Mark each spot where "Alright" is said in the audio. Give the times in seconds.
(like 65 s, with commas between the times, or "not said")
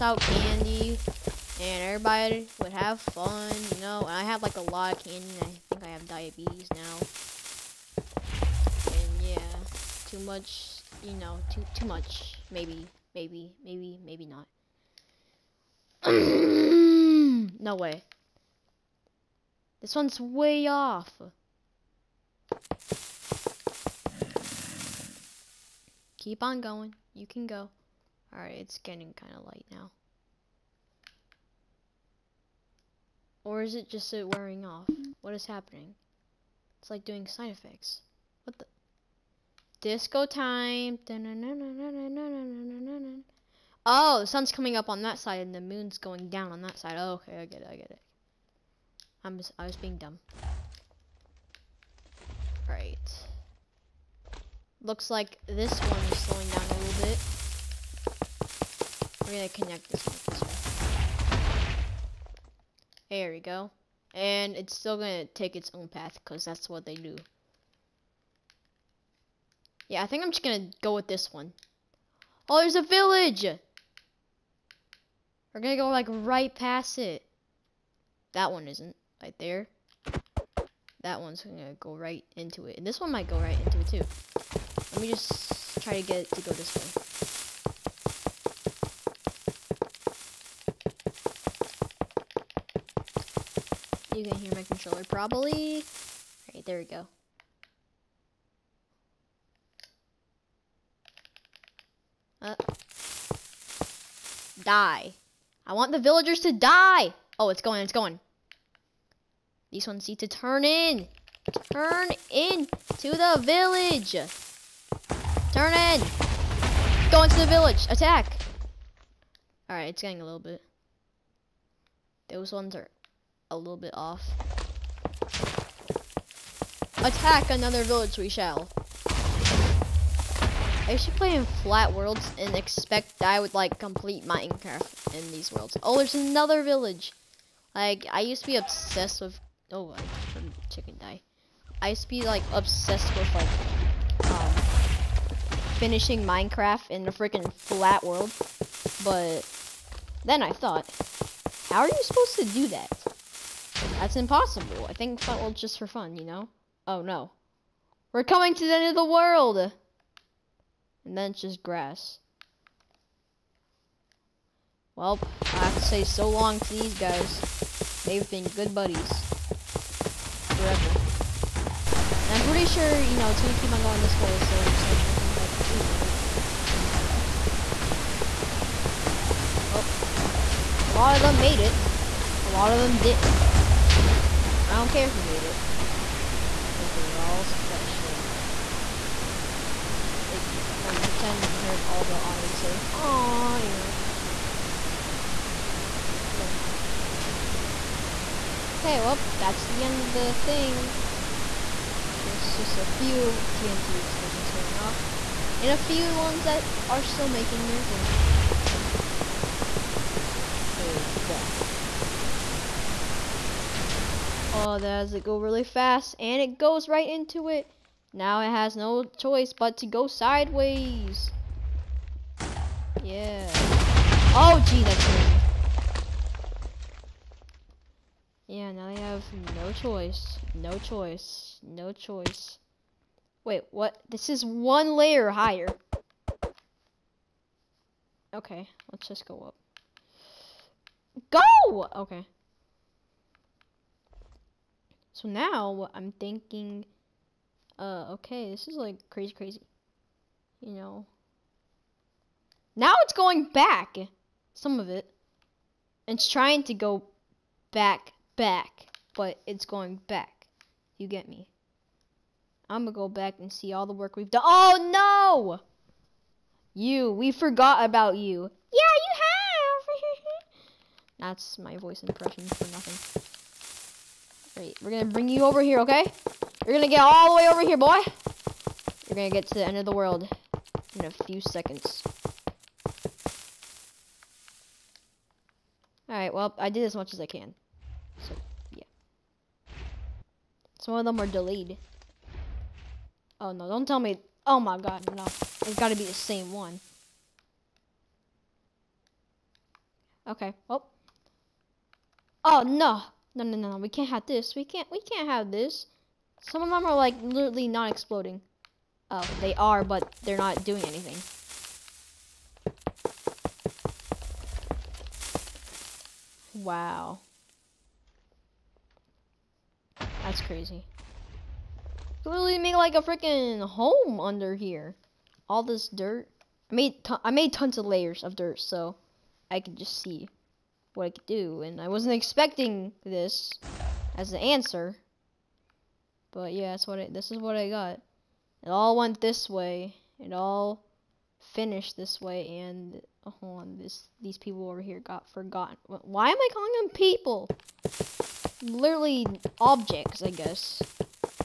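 28 s, 96 s, 286 s.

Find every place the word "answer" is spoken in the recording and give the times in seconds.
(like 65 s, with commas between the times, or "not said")
334 s.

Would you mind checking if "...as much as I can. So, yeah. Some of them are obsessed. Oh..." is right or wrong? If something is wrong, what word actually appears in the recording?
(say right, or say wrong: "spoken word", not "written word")
wrong: "delayed", not "obsessed".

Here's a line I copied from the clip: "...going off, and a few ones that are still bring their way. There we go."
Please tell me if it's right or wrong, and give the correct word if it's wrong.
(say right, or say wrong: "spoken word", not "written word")
wrong: "making", not "bring".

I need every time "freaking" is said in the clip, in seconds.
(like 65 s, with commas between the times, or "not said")
147 s, 323 s.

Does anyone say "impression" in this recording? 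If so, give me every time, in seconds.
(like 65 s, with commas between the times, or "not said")
272 s.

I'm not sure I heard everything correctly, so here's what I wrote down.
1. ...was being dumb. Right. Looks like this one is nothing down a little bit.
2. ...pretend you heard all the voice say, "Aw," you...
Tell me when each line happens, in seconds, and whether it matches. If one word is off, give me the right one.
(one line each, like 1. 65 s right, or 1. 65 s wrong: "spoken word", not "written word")
1. 49 s wrong: "slowing", not "nothing"
2. 190 s wrong: "audience", not "voice".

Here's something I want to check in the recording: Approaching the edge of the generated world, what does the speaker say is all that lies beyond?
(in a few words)
Grass.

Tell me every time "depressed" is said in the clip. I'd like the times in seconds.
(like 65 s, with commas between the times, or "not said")
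not said.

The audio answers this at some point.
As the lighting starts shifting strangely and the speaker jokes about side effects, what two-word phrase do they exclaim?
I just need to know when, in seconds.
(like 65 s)
39 s.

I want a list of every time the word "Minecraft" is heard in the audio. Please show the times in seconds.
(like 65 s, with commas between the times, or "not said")
134 s, 146 s.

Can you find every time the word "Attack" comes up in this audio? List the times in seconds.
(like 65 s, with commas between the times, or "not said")
117 s, 126 s.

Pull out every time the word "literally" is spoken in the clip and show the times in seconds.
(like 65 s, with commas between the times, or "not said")
307 s, 322 s, 348 s.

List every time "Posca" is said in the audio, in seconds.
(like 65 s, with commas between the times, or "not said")
not said.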